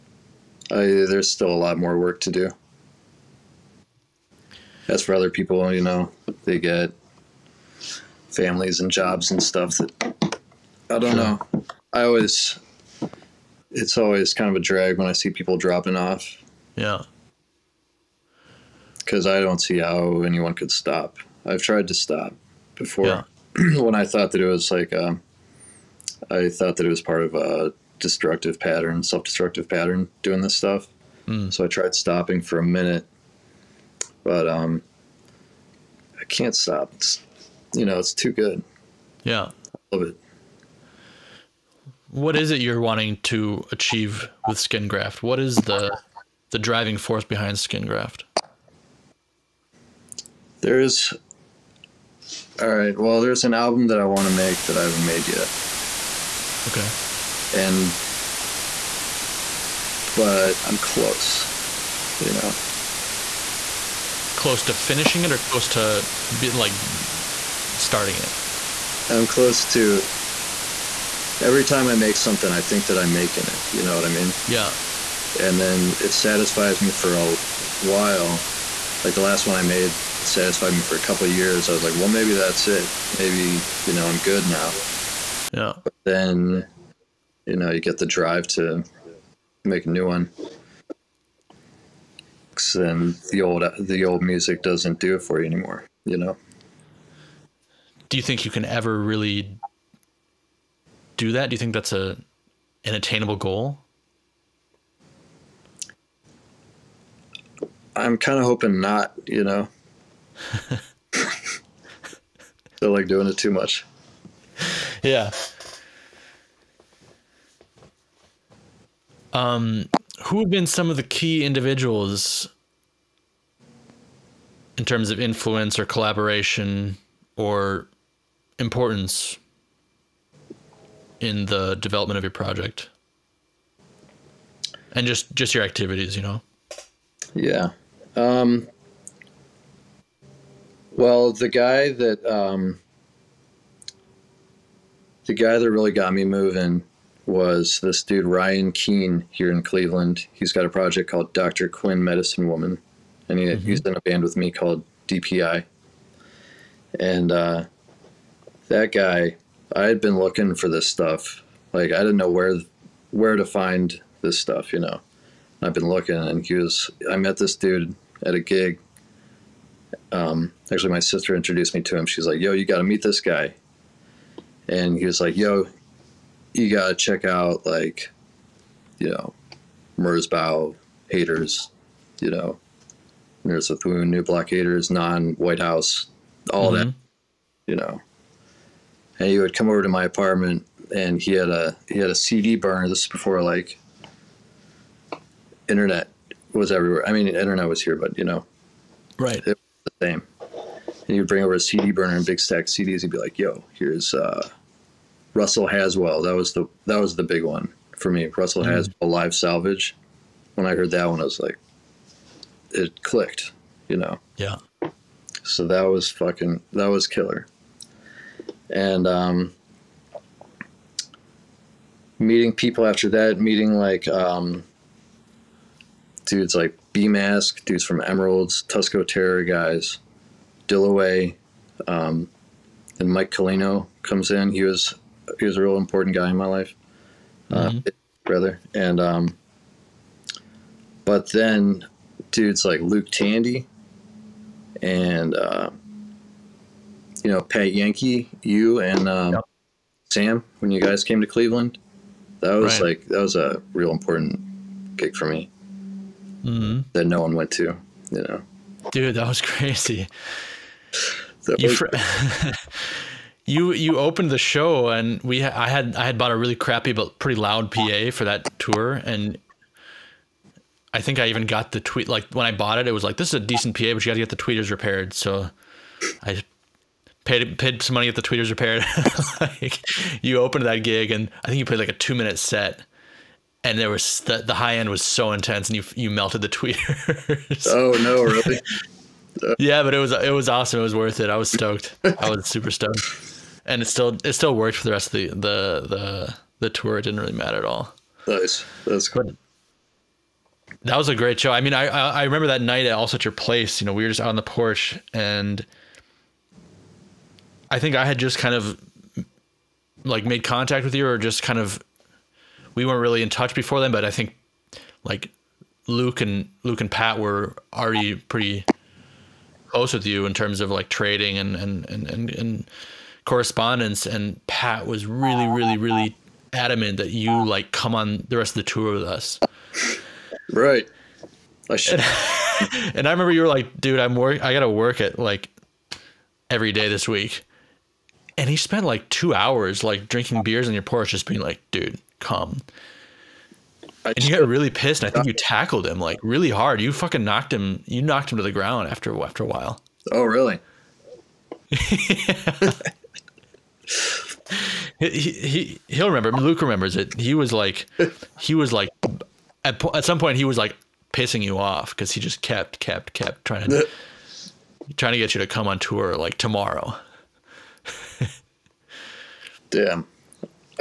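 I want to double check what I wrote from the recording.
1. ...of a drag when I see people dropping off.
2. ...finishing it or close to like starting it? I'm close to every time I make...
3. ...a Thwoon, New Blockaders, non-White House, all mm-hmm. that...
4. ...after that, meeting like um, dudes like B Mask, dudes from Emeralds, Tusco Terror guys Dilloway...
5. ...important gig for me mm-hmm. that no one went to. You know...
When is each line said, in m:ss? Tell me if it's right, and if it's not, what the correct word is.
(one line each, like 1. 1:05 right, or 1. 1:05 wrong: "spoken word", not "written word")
1. 0:14 right
2. 1:04 right
3. 3:03 right
4. 3:42 right
5. 4:13 right.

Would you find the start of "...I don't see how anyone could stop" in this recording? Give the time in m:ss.
0:19.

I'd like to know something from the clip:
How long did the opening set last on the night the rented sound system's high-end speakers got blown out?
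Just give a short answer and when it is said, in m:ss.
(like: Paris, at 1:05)
2 minutes, at 4:41.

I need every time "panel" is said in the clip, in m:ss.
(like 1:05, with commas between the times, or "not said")
not said.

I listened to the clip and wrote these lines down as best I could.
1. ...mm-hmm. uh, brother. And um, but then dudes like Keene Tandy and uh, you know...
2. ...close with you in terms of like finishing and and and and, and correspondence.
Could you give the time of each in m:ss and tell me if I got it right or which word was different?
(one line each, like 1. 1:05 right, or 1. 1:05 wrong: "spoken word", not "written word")
1. 3:57 wrong: "Luke", not "Keene"
2. 5:19 wrong: "trading", not "finishing".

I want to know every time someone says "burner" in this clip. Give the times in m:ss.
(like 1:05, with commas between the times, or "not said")
3:12, 3:21.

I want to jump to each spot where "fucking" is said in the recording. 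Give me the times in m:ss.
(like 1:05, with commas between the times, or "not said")
3:36, 5:46.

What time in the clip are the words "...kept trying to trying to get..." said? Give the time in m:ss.
6:03.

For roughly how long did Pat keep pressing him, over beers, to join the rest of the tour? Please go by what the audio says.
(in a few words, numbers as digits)
2 hours.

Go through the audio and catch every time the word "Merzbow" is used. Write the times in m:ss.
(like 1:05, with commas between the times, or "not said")
2:59.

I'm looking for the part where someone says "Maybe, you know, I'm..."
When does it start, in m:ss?
1:23.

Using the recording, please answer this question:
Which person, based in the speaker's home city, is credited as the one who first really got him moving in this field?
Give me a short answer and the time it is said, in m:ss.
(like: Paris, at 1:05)
Ryan Keene, at 2:28.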